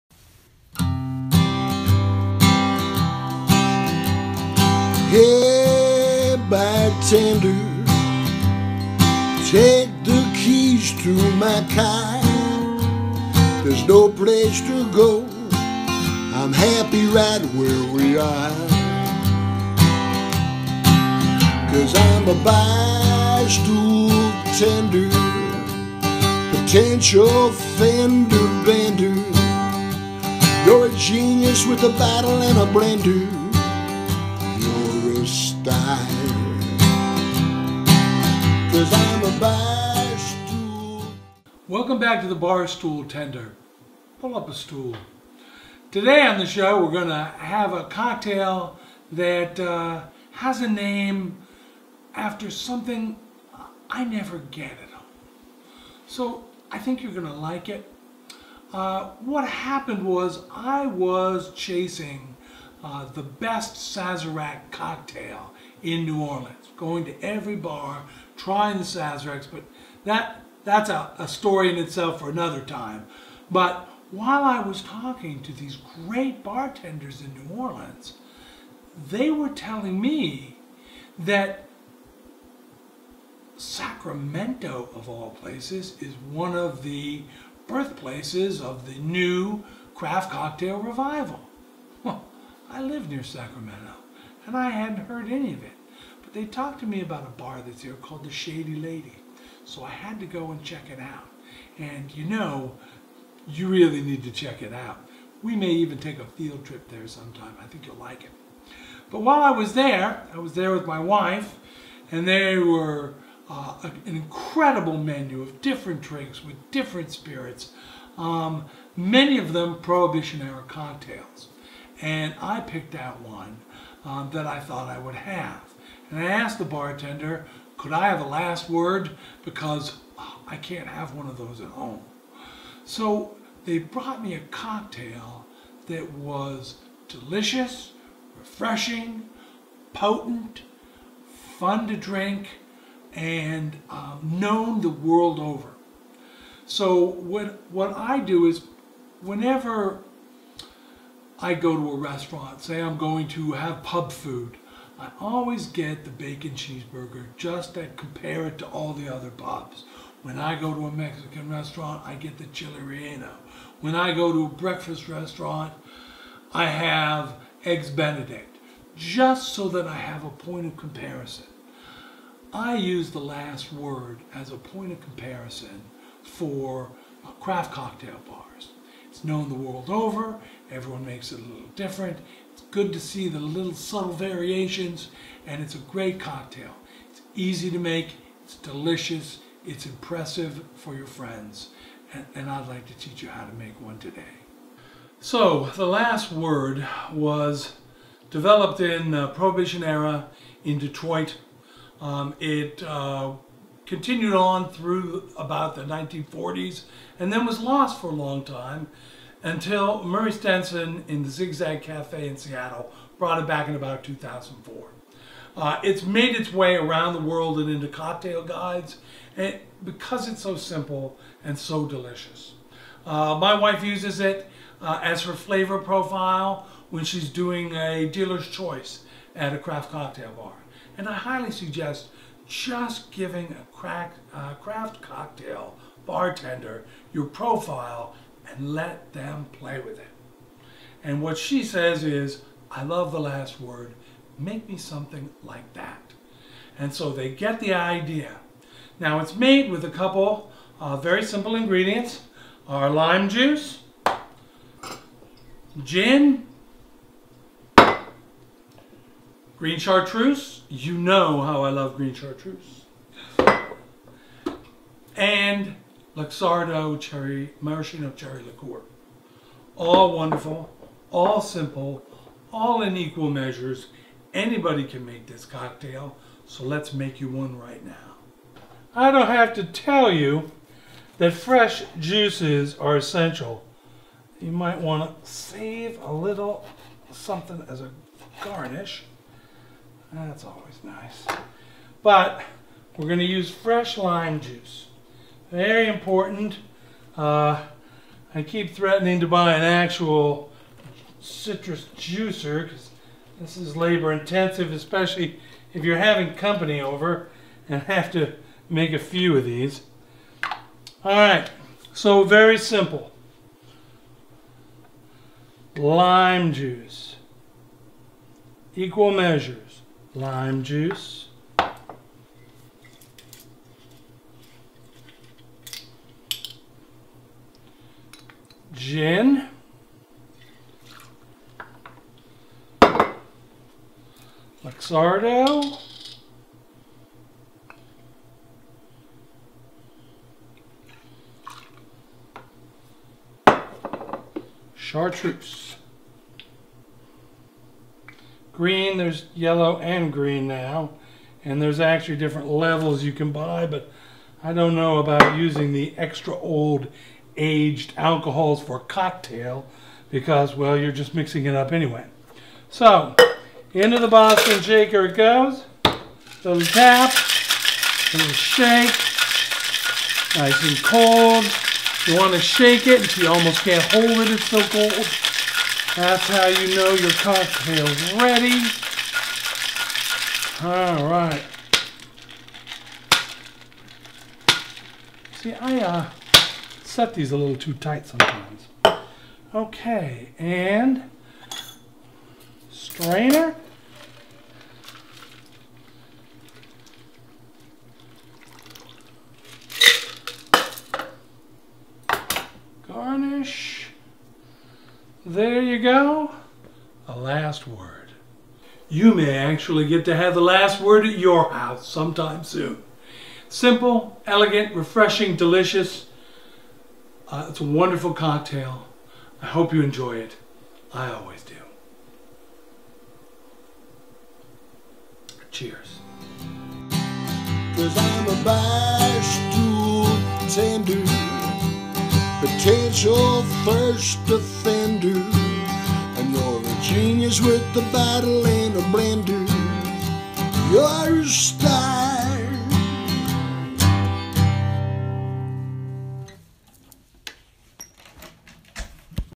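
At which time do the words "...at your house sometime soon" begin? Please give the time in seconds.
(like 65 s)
411 s.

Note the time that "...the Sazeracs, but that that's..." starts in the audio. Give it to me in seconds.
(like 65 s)
68 s.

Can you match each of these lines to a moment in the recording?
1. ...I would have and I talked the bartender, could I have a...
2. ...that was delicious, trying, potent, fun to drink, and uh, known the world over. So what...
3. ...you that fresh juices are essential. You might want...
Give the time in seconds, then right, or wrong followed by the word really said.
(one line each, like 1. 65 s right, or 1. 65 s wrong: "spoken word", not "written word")
1. 124 s wrong: "asked", not "talked"
2. 135 s wrong: "refreshing", not "trying"
3. 280 s right.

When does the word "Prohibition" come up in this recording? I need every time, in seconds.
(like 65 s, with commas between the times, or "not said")
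119 s, 199 s.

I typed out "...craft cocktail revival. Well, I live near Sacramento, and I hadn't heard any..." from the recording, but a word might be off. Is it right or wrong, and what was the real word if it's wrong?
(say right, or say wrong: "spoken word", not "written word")
right.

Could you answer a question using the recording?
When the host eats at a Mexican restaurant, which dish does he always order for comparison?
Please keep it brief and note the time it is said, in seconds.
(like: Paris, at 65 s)
chili relleno, at 162 s.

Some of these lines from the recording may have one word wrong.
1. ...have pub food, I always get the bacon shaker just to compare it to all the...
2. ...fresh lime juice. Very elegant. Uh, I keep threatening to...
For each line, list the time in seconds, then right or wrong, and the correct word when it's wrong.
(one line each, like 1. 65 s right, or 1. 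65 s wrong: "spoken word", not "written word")
1. 153 s wrong: "cheeseburger", not "shaker"
2. 293 s wrong: "important", not "elegant".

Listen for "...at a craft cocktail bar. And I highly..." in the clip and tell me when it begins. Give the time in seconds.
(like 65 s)
229 s.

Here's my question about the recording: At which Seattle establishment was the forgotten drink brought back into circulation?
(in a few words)
Zigzag Cafe.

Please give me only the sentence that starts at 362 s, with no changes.
So, into the Boston shaker it goes.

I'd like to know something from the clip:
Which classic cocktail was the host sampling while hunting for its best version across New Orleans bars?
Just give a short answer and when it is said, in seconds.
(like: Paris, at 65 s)
Sazerac, at 63 s.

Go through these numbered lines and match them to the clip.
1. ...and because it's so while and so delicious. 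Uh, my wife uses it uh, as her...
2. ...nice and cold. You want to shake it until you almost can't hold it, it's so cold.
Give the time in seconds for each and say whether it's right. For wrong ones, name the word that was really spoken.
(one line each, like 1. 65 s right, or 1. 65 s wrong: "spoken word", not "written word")
1. 219 s wrong: "simple", not "while"
2. 370 s right.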